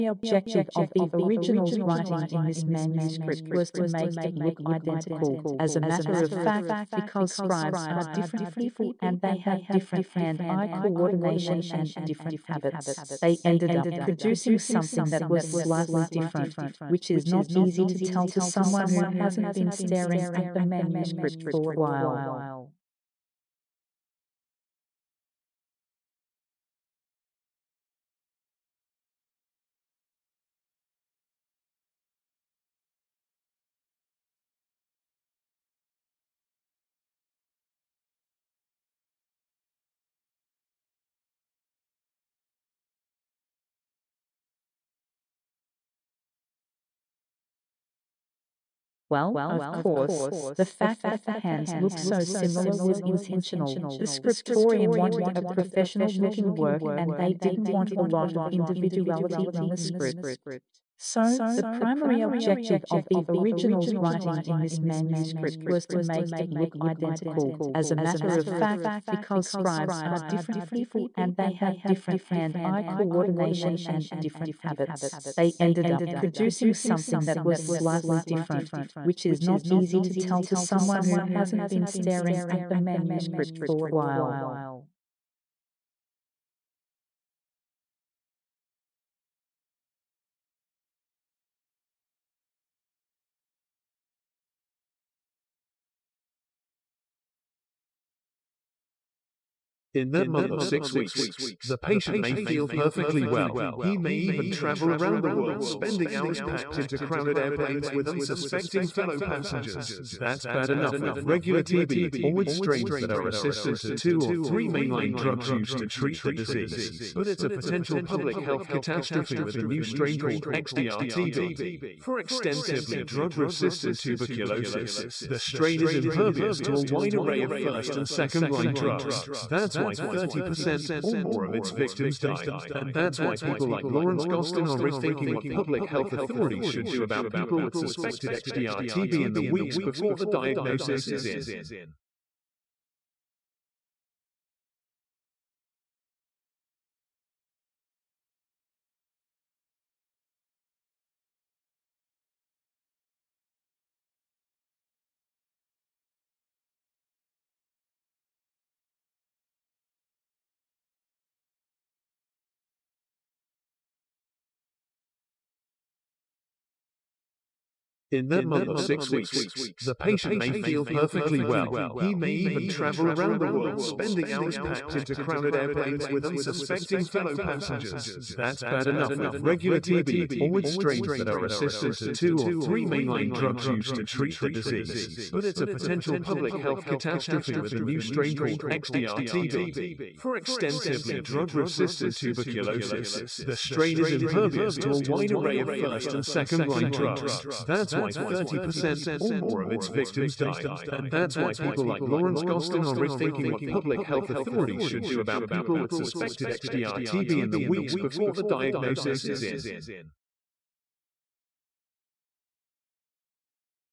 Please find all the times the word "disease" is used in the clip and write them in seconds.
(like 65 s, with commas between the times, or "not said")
116 s, 184 s.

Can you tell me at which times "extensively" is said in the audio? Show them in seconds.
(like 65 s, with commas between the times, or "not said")
122 s, 190 s.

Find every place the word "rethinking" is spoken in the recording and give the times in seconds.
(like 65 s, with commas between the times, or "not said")
134 s, 202 s.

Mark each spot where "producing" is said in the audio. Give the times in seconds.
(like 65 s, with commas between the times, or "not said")
13 s, 76 s.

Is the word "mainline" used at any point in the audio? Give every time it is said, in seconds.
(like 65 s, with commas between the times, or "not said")
114 s, 182 s.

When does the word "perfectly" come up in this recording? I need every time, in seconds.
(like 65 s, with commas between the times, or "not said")
102 s, 170 s.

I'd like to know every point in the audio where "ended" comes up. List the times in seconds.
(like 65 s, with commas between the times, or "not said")
13 s, 75 s.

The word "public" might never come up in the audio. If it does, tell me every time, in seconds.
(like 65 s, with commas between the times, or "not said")
117 s, 135 s, 186 s, 203 s.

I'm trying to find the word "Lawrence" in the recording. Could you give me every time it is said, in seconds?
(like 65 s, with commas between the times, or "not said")
133 s, 202 s.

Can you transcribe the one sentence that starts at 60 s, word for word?
So, the primary objective of the original's writing in this manuscript was to make it look identical.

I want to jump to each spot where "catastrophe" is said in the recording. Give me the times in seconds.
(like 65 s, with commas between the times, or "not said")
118 s, 186 s.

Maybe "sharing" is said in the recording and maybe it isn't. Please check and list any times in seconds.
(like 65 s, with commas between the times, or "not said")
not said.